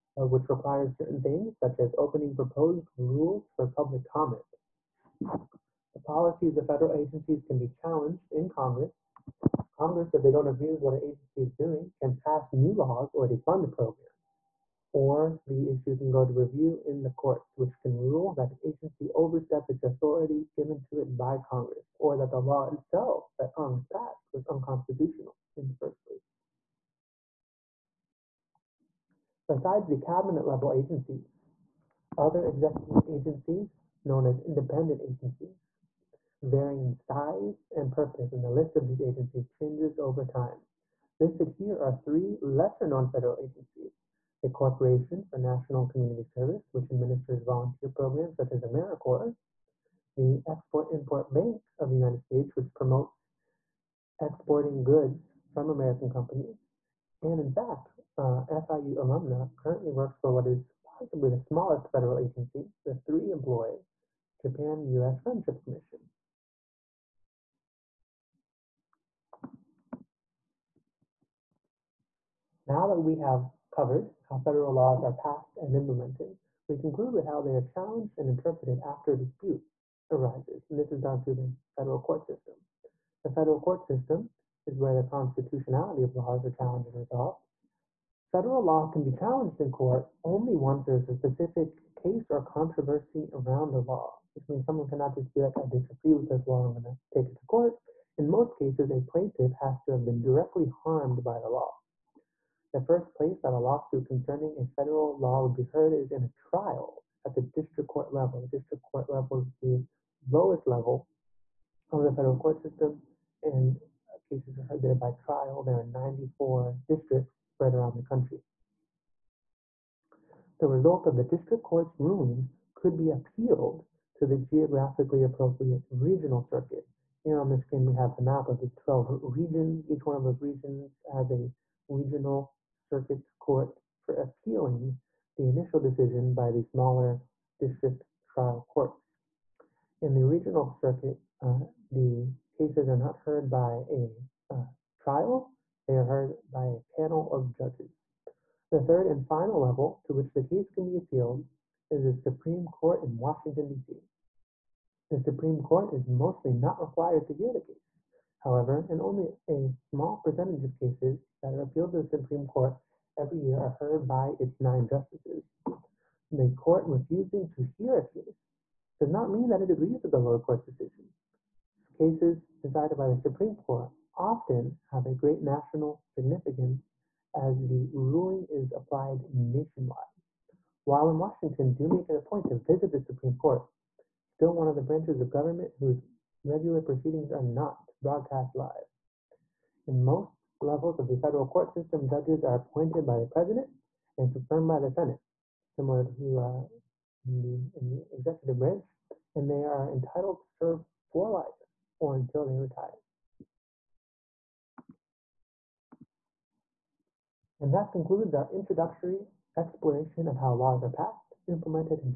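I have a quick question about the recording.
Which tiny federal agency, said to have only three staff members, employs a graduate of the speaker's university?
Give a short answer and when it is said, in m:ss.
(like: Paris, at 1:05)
Japan US Friendship Commission, at 1:04.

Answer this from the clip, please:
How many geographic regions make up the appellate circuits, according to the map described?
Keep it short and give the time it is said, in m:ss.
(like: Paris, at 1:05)
12, at 2:08.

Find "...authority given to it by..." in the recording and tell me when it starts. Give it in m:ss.
0:19.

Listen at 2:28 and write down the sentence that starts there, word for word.
The third and final level to which the case can be appealed is the Supreme Court in Washington, D.C.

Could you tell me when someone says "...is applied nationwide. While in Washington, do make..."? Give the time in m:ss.
2:58.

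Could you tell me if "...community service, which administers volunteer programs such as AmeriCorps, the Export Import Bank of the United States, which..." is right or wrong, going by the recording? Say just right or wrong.
right.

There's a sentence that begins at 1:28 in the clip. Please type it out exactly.
Federal law can be challenged in court only once there's a specific case or controversy around a law.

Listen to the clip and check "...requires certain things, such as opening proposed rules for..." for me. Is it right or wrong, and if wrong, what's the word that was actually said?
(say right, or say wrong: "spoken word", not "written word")
right.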